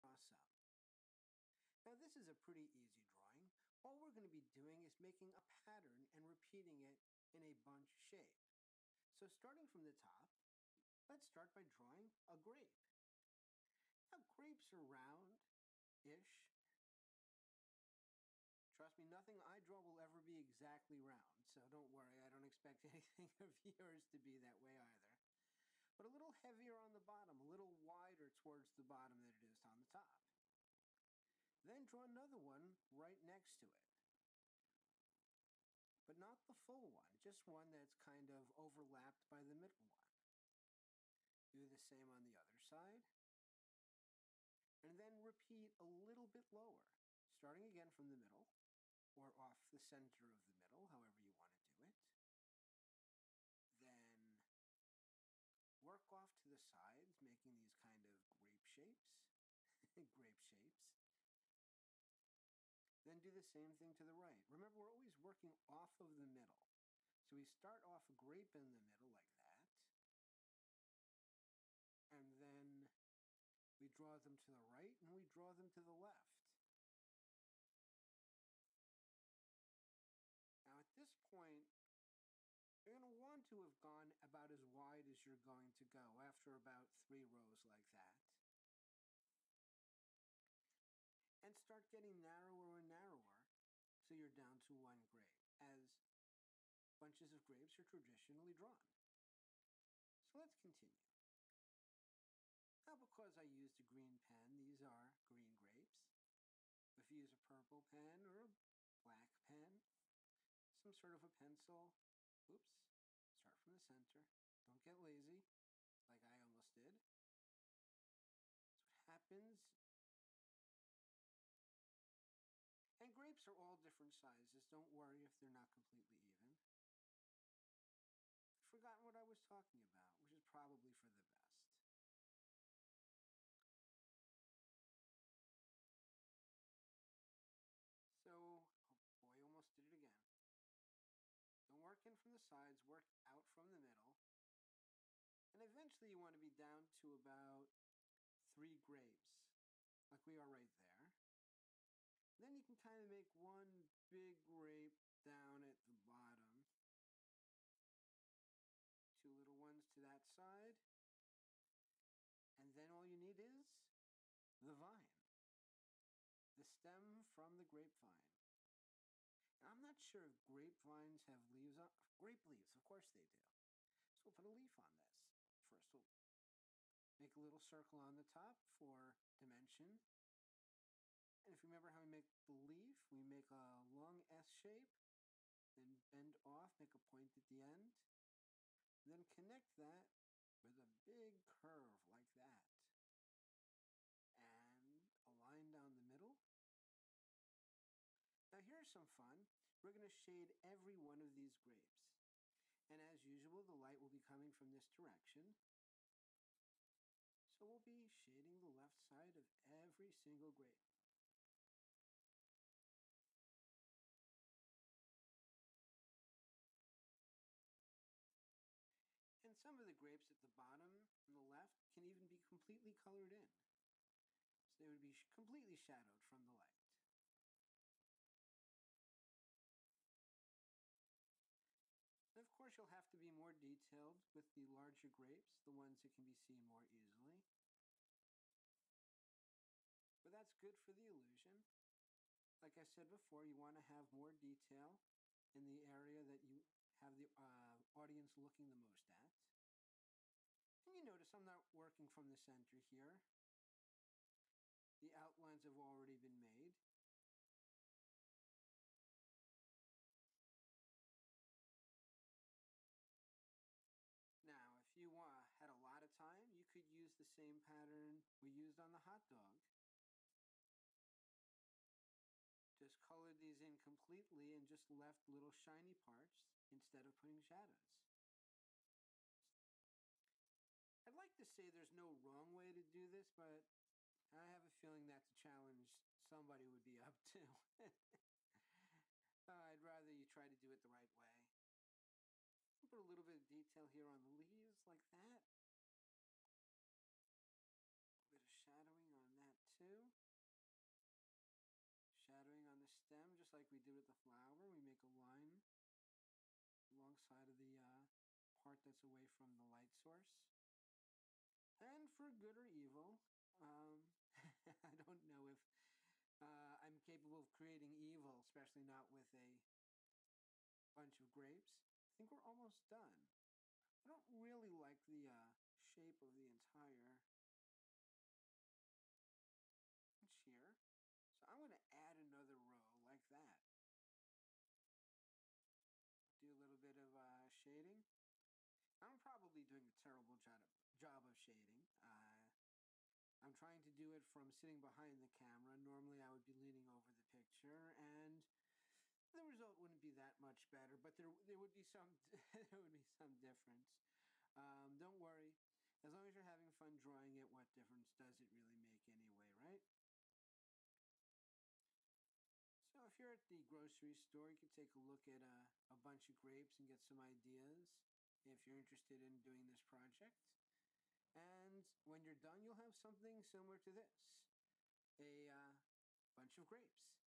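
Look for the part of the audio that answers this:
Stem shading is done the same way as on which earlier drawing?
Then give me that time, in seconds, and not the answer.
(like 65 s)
304 s.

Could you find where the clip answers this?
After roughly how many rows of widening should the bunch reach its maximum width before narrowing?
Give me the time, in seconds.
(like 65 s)
87 s.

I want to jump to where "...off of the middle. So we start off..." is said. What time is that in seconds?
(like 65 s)
65 s.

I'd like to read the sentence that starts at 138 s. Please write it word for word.
So, oh boy, almost did it again.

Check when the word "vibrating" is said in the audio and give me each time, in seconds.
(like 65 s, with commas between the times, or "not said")
not said.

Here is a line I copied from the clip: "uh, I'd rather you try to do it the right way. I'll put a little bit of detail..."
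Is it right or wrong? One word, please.
right.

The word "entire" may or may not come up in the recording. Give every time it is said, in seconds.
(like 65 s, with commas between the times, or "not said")
326 s.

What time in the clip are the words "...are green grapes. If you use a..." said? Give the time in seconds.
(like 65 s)
104 s.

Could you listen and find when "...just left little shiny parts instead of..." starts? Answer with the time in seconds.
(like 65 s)
274 s.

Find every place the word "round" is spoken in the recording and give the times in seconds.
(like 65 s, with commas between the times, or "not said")
14 s, 21 s.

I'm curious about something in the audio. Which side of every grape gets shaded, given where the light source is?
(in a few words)
the left side.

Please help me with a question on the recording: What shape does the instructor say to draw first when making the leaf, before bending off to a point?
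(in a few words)
a long S shape.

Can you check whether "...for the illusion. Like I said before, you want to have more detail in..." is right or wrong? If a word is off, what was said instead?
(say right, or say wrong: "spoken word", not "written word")
right.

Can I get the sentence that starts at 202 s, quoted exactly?
And as usual, the light will be coming from this direction.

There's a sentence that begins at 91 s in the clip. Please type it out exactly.
And start getting narrower you're down to one grape, as bunches of grapes are traditionally drawn.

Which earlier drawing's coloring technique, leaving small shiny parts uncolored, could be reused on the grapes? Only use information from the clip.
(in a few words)
the hot dog.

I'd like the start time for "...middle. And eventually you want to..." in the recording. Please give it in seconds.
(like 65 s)
143 s.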